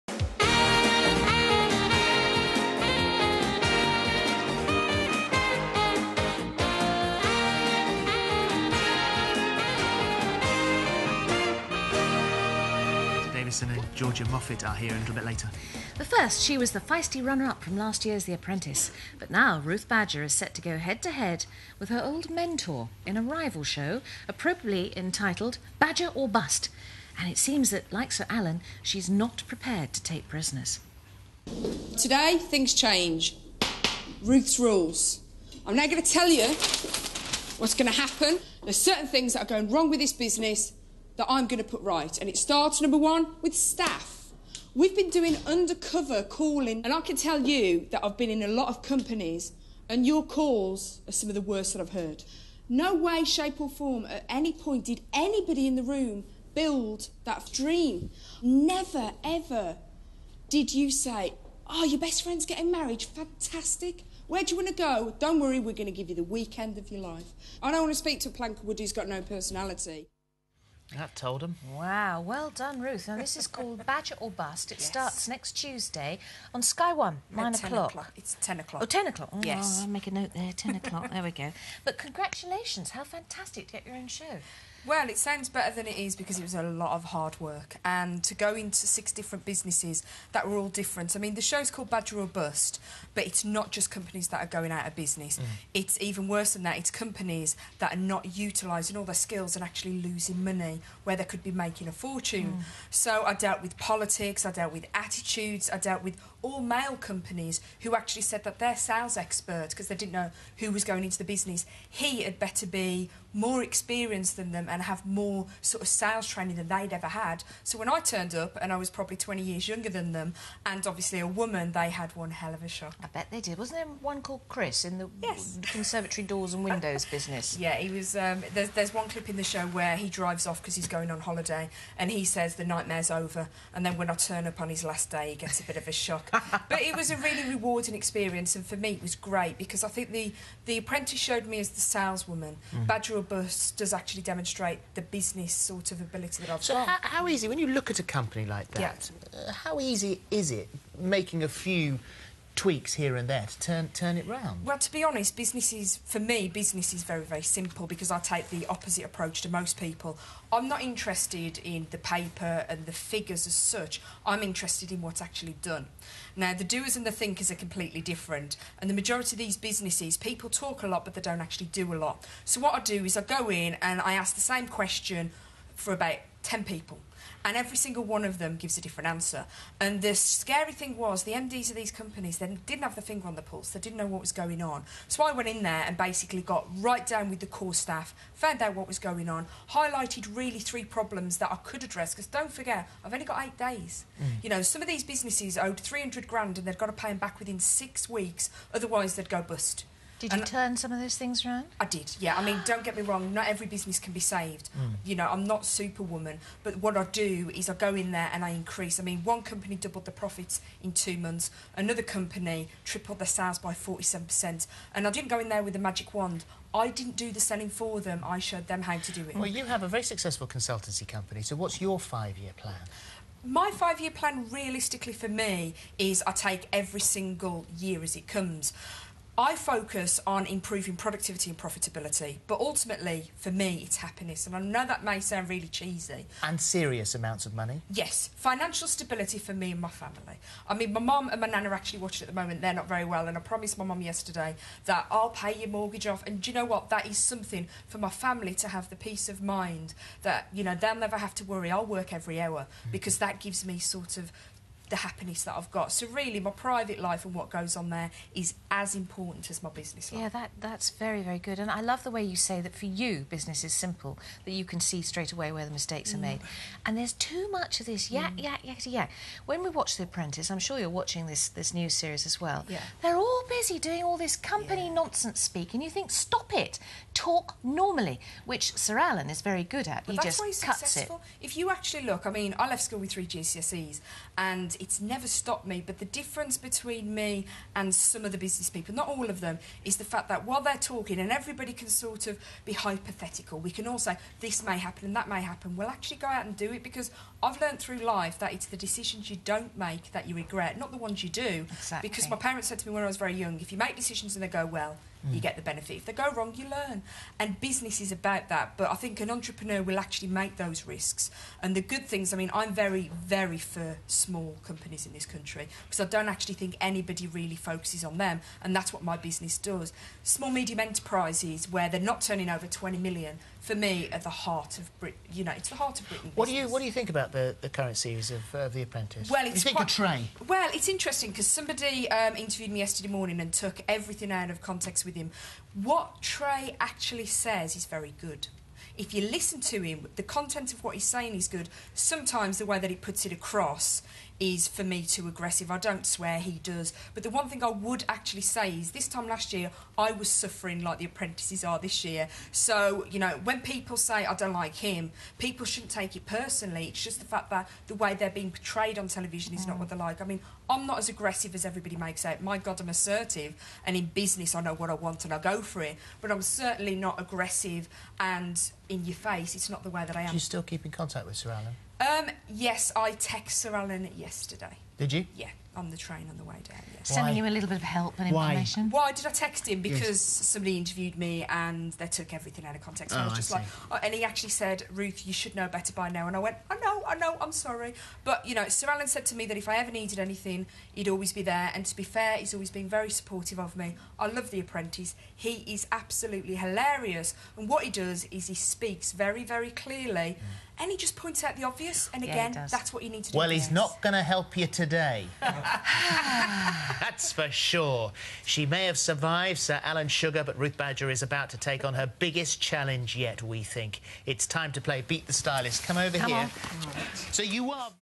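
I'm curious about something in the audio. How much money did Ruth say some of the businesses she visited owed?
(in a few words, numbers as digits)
300 grand.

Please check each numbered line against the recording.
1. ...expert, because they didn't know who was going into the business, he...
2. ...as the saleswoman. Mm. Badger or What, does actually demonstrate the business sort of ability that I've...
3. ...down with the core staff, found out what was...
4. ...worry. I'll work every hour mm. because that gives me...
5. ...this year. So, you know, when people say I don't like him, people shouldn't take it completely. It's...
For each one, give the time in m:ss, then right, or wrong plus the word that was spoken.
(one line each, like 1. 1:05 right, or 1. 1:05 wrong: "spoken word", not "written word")
1. 1:49 right
2. 2:21 wrong: "Bust", not "What"
3. 3:07 right
4. 4:11 right
5. 5:51 wrong: "personally", not "completely".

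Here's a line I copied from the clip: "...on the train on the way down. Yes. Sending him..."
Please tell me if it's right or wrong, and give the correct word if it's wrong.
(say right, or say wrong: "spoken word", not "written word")
right.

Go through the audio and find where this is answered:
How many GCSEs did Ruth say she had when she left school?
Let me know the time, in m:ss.
4:43.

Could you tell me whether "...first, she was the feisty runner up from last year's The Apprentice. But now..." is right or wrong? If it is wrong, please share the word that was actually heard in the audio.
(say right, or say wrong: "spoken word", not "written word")
right.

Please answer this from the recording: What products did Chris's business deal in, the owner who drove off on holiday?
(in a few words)
conservatory doors and windows.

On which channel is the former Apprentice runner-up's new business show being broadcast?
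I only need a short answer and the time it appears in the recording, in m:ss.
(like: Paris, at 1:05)
Sky One, at 1:16.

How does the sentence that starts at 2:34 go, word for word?
Well, to be honest, business is for me business is very very simple because I take the opposite approach to most people.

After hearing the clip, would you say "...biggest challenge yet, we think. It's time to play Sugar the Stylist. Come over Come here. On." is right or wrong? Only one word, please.
wrong.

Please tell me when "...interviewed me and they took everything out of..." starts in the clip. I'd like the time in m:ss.
6:20.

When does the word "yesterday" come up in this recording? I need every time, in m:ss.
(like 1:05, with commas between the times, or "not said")
4:04, 5:32, 6:14.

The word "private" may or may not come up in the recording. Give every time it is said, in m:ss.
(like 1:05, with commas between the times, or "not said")
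4:16.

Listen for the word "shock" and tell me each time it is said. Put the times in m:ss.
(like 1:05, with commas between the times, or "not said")
2:02, 2:15.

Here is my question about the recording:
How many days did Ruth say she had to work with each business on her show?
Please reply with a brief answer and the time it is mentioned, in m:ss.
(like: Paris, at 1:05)
8, at 3:13.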